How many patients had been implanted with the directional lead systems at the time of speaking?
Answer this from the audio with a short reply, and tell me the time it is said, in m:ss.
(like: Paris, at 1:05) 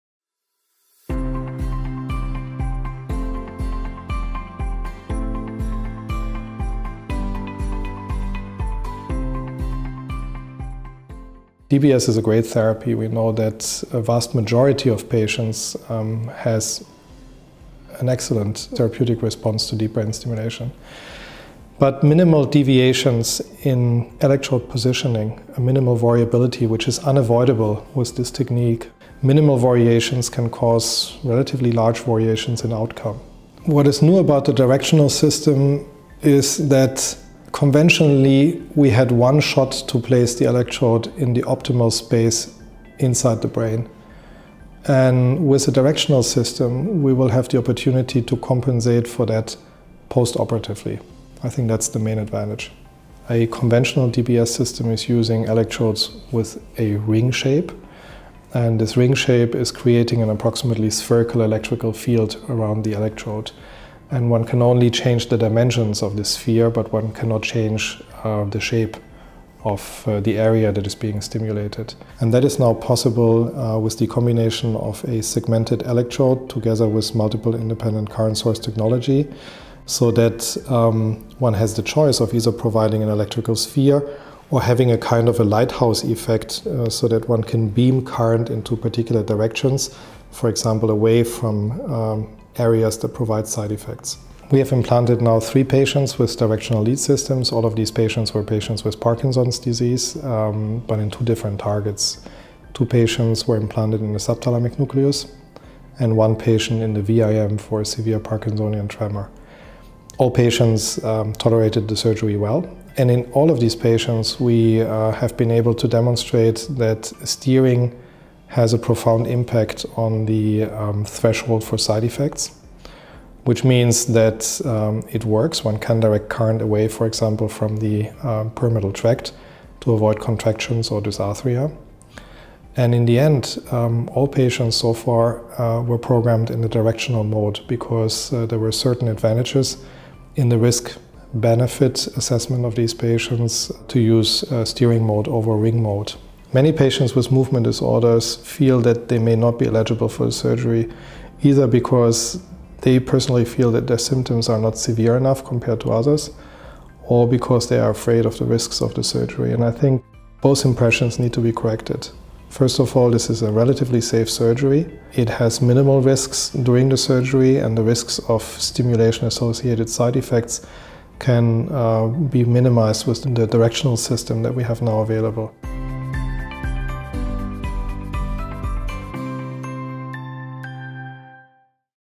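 3, at 1:35.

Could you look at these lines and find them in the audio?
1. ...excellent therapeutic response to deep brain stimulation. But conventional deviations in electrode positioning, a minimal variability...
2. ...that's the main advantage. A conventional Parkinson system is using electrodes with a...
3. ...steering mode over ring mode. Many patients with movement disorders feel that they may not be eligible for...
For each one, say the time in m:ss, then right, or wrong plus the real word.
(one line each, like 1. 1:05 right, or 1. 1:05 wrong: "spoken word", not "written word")
1. 0:18 wrong: "minimal", not "conventional"
2. 0:51 wrong: "DBS", not "Parkinson"
3. 2:24 right.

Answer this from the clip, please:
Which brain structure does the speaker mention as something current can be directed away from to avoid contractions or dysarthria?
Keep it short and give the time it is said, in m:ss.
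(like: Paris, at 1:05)
Pyramidal tract, at 2:08.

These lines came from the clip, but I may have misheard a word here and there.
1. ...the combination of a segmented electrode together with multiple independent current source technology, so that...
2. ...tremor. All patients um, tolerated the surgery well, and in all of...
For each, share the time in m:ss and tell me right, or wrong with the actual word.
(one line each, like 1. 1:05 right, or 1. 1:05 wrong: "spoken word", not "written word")
1. 1:13 right
2. 1:48 right.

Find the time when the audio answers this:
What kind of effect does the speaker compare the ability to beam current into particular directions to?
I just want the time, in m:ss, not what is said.
1:25.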